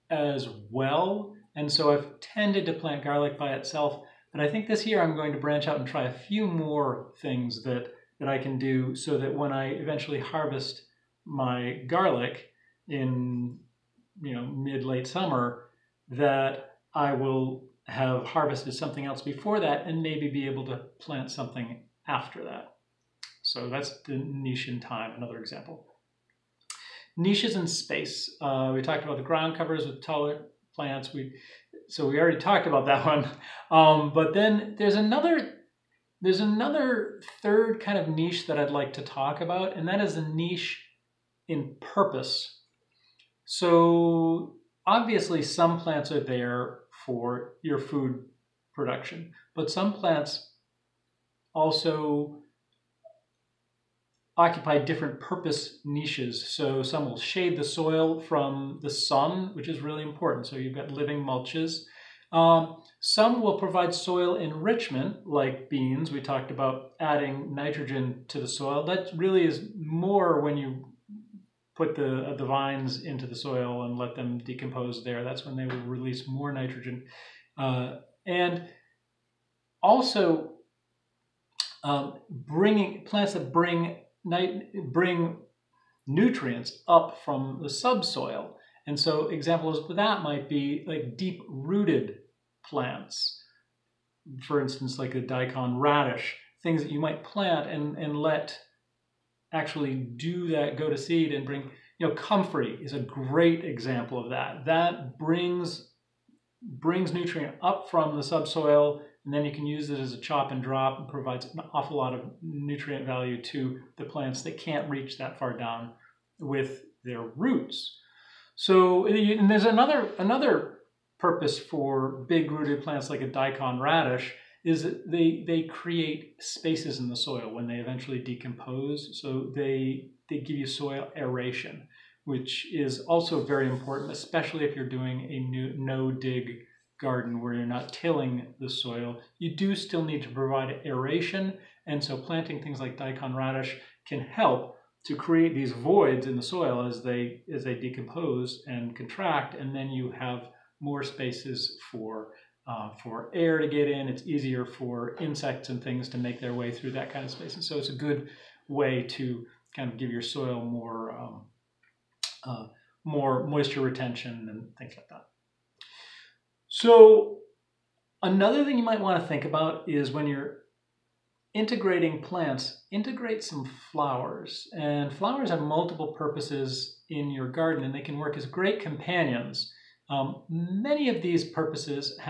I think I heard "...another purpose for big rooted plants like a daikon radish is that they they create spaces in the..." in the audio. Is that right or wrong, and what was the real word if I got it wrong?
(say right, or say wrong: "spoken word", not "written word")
right.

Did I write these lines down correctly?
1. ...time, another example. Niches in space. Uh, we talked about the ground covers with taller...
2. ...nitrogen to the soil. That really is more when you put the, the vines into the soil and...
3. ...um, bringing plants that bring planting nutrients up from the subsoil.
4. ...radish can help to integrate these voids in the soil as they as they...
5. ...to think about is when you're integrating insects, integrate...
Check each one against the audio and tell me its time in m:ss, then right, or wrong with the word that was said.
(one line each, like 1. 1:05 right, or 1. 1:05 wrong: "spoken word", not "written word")
1. 0:24 right
2. 1:07 right
3. 1:21 wrong: "bring", not "planting"
4. 2:23 wrong: "create", not "integrate"
5. 2:49 wrong: "plants", not "insects".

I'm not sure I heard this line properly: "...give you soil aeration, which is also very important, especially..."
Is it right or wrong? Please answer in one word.
right.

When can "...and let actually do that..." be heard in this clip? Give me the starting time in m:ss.
1:37.